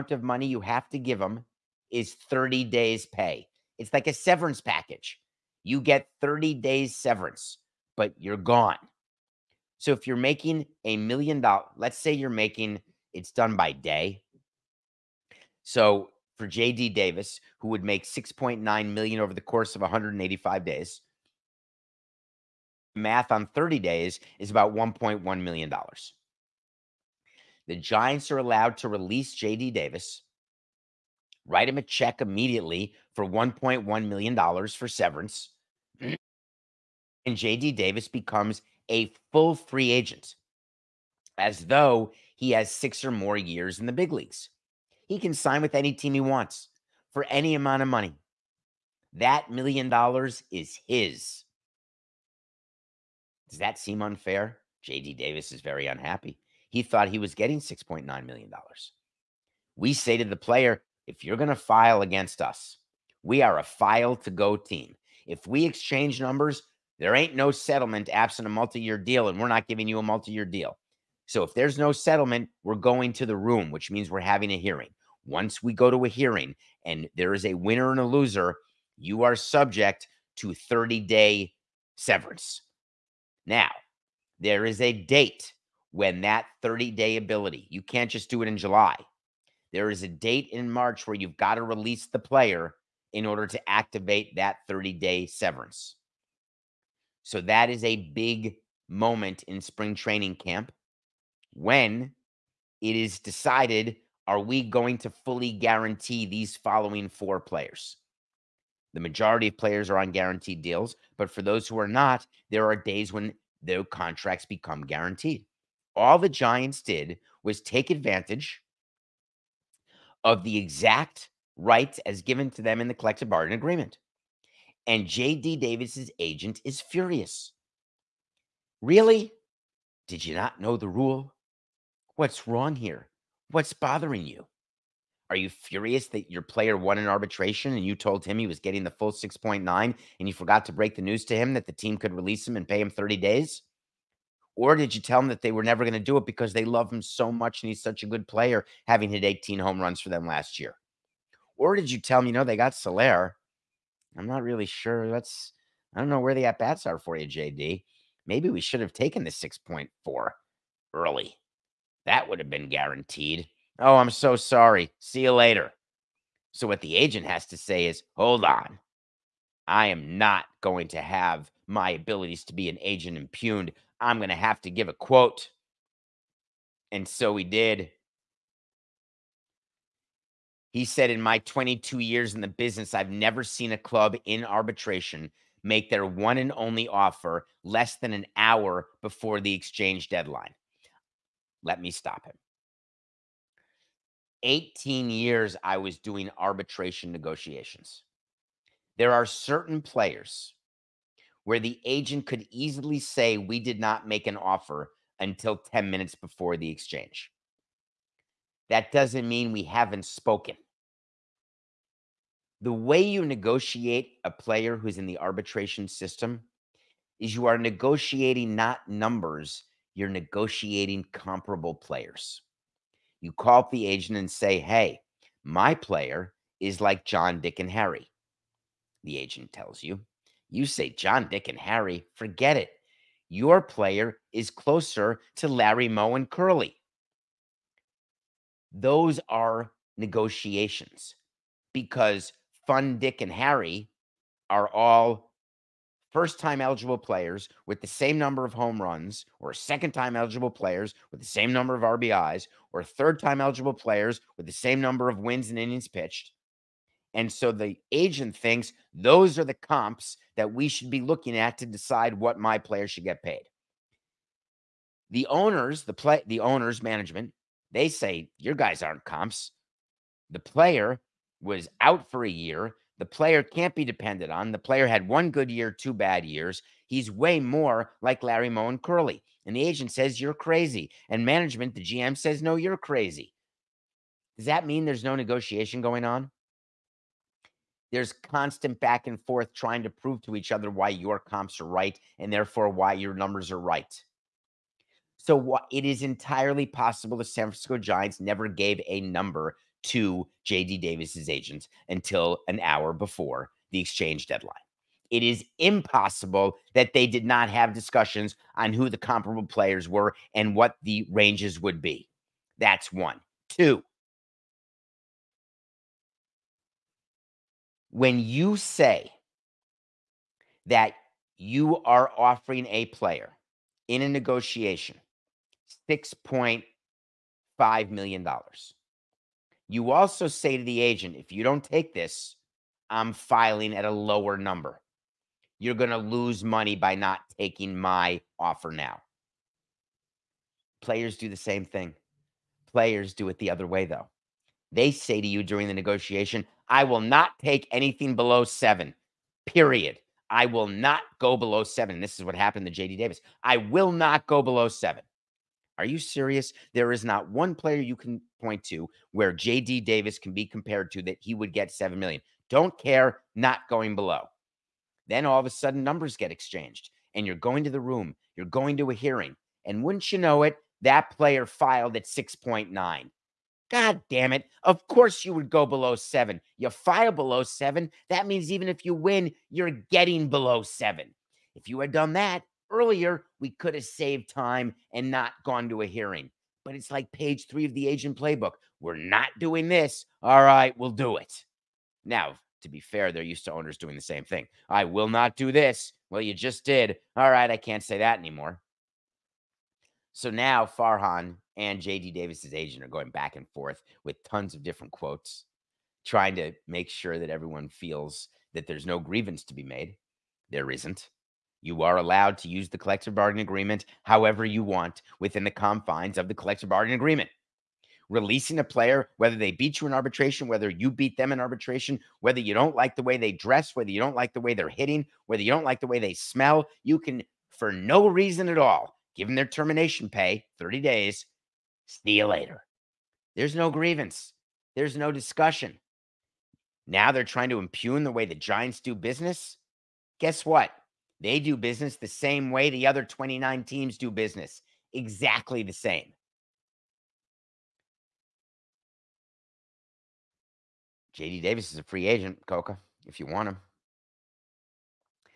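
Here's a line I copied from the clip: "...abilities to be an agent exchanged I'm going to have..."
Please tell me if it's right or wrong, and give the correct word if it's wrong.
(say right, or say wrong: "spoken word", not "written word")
wrong: "impugned", not "exchanged".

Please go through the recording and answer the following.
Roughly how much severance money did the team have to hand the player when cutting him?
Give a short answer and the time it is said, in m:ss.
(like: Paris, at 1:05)
$1.1 million, at 0:24.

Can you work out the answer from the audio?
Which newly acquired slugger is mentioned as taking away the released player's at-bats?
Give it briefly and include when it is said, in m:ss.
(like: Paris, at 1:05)
Soler, at 2:32.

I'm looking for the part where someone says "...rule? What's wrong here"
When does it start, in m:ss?
2:10.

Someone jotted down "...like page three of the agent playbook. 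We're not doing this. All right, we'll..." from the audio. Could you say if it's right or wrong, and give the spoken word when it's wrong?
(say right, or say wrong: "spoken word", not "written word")
right.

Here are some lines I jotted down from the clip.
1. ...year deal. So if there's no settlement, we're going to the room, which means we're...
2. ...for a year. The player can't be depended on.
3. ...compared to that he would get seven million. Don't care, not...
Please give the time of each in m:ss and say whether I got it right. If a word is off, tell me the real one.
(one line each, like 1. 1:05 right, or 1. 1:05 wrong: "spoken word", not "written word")
1. 1:10 right
2. 4:32 right
3. 6:00 right.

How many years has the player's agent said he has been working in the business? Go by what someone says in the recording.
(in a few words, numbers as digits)
22.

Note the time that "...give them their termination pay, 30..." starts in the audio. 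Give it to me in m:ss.
7:09.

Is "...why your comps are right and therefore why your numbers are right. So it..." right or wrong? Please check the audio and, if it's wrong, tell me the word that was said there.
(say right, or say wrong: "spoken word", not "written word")
right.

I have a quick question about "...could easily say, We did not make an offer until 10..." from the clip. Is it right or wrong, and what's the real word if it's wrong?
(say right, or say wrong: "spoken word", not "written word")
right.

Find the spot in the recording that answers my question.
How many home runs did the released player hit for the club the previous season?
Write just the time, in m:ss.
2:29.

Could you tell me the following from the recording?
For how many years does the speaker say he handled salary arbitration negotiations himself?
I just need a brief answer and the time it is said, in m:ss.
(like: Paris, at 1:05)
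18, at 3:14.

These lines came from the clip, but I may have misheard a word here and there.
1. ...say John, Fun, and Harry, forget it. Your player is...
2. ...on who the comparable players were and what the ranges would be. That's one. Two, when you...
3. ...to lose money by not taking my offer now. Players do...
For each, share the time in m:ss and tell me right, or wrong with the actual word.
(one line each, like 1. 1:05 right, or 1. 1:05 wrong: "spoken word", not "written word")
1. 3:50 wrong: "Dick", not "Fun"
2. 5:08 right
3. 5:35 right.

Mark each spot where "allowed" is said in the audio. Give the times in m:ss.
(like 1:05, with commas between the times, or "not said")
0:28, 6:51.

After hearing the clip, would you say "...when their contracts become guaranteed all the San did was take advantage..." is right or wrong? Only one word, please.
wrong.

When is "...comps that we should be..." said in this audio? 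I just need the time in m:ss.
4:19.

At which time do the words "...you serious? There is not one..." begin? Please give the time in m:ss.
5:55.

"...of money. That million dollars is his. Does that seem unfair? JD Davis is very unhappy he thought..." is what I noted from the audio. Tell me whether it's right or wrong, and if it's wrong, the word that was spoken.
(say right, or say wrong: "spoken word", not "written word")
right.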